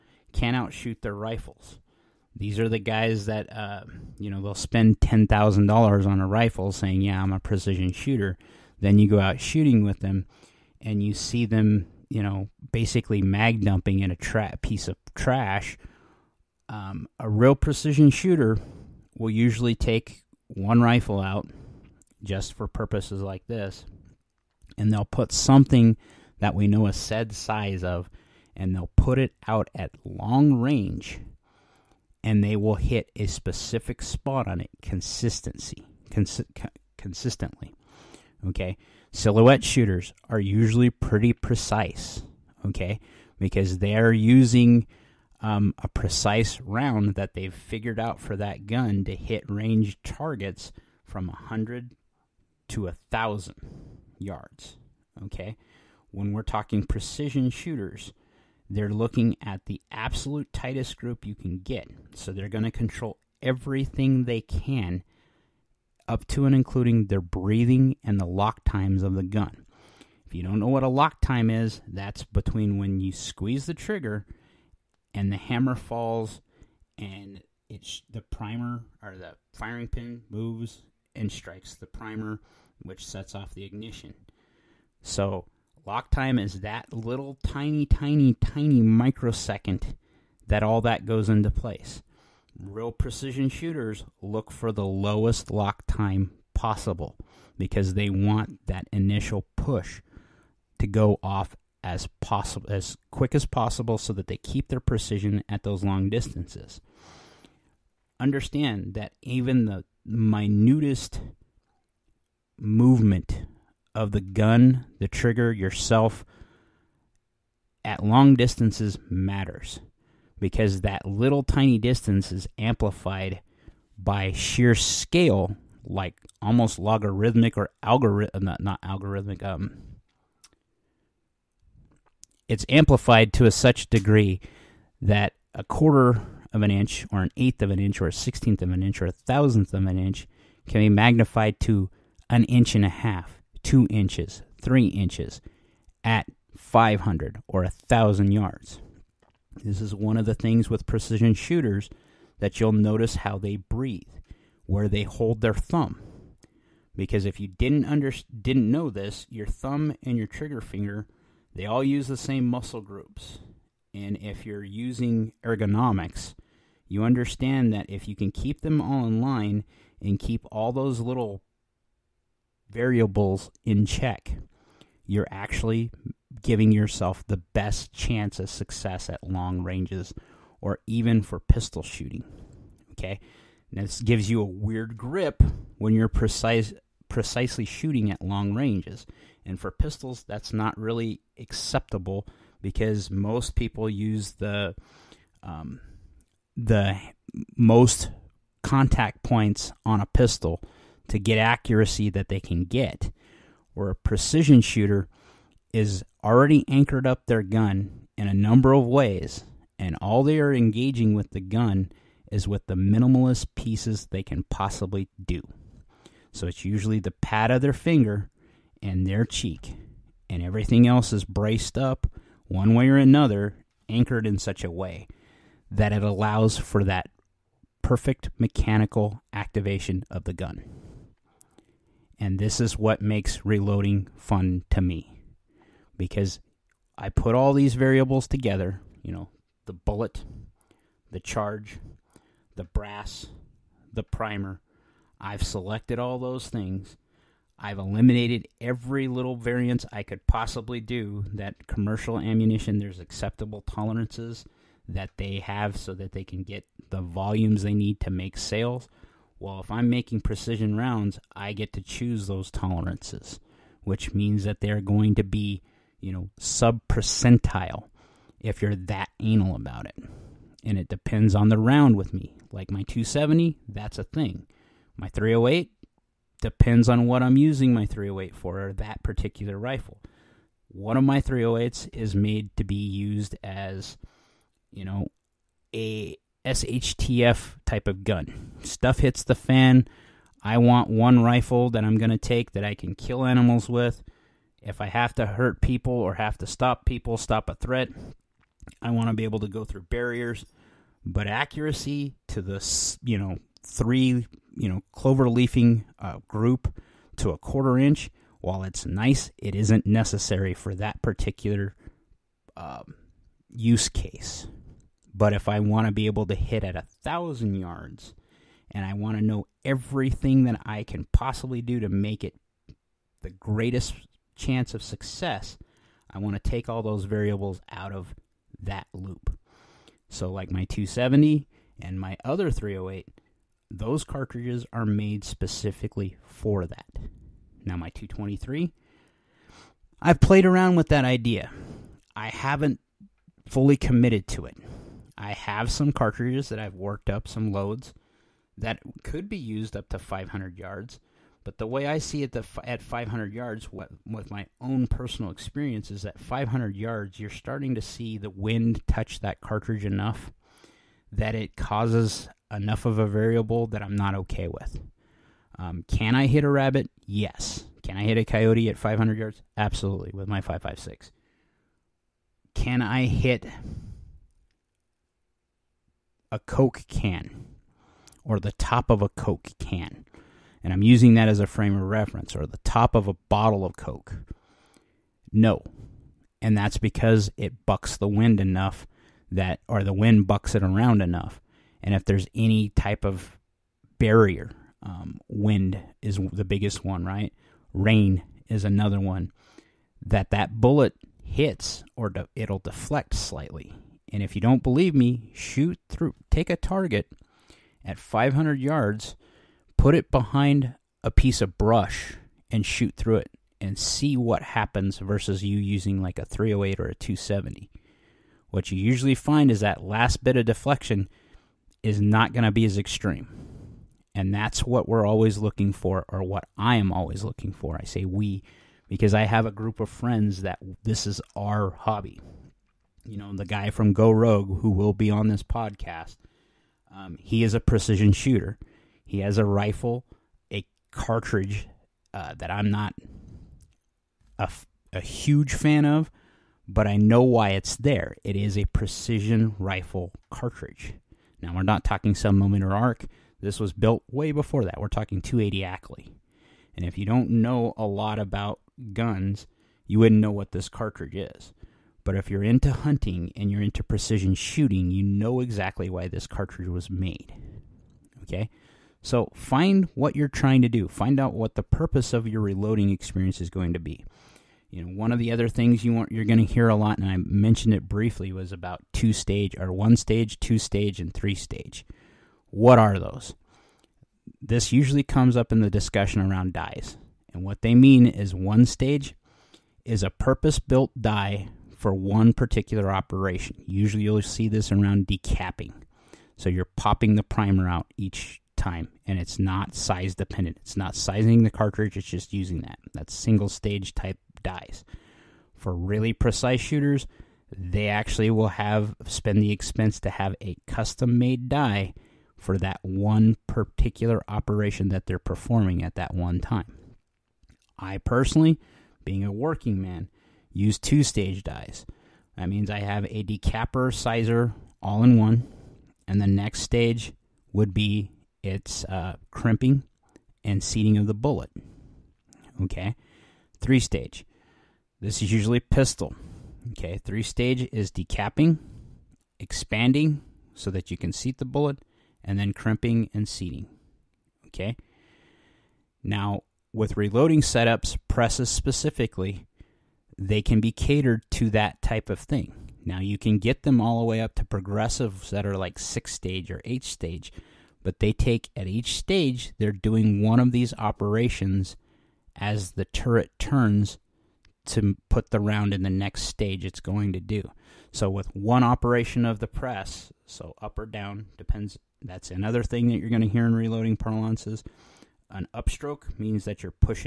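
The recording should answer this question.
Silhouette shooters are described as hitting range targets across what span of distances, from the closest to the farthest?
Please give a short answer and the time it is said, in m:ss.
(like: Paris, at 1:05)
100 to 1,000 yards, at 0:51.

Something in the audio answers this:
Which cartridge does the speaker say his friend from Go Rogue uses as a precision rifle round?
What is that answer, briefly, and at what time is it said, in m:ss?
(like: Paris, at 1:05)
280 Ackley, at 7:35.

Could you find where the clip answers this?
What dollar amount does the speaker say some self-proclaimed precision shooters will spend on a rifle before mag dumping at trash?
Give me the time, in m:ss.
0:04.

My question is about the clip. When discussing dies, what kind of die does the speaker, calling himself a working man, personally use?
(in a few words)
Two stage dies.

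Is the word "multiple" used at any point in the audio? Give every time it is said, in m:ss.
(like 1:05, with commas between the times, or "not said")
not said.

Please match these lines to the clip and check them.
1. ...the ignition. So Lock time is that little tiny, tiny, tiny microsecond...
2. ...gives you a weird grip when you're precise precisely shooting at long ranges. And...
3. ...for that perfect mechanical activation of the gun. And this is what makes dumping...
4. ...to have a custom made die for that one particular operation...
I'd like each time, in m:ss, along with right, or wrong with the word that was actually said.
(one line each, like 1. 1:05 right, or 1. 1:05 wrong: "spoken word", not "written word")
1. 1:23 right
2. 3:04 right
3. 3:46 wrong: "reloading", not "dumping"
4. 8:30 right.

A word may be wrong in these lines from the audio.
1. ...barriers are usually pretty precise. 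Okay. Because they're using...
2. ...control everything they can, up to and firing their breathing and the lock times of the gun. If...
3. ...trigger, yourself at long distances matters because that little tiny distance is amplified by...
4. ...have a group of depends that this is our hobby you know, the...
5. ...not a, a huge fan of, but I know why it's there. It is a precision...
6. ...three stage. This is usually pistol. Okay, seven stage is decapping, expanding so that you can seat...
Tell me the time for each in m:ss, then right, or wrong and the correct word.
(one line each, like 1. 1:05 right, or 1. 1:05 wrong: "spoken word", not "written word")
1. 0:39 wrong: "shooters", not "barriers"
2. 1:02 wrong: "including", not "firing"
3. 1:55 right
4. 7:09 wrong: "friends", not "depends"
5. 7:22 right
6. 8:53 wrong: "three", not "seven".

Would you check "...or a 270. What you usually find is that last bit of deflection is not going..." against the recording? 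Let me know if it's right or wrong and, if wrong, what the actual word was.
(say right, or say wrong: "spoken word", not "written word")
right.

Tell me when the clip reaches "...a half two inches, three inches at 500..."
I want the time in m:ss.
2:22.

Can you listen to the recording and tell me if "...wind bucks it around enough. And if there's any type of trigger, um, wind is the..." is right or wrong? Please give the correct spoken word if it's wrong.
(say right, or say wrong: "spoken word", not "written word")
wrong: "barrier", not "trigger".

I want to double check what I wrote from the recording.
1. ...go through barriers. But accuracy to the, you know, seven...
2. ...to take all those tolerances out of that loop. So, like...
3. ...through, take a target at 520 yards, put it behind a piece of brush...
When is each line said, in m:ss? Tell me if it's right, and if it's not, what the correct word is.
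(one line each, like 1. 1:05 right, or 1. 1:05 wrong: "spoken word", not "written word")
1. 4:59 wrong: "three", not "seven"
2. 5:26 wrong: "variables", not "tolerances"
3. 6:45 wrong: "500", not "520".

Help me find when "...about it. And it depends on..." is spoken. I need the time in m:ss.
4:29.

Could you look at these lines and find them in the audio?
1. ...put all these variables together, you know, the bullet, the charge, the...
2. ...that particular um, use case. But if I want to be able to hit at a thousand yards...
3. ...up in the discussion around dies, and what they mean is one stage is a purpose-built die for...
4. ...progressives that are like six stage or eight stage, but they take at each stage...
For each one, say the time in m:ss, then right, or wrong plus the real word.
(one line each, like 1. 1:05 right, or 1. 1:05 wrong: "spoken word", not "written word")
1. 3:57 right
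2. 5:10 right
3. 8:05 right
4. 9:14 right.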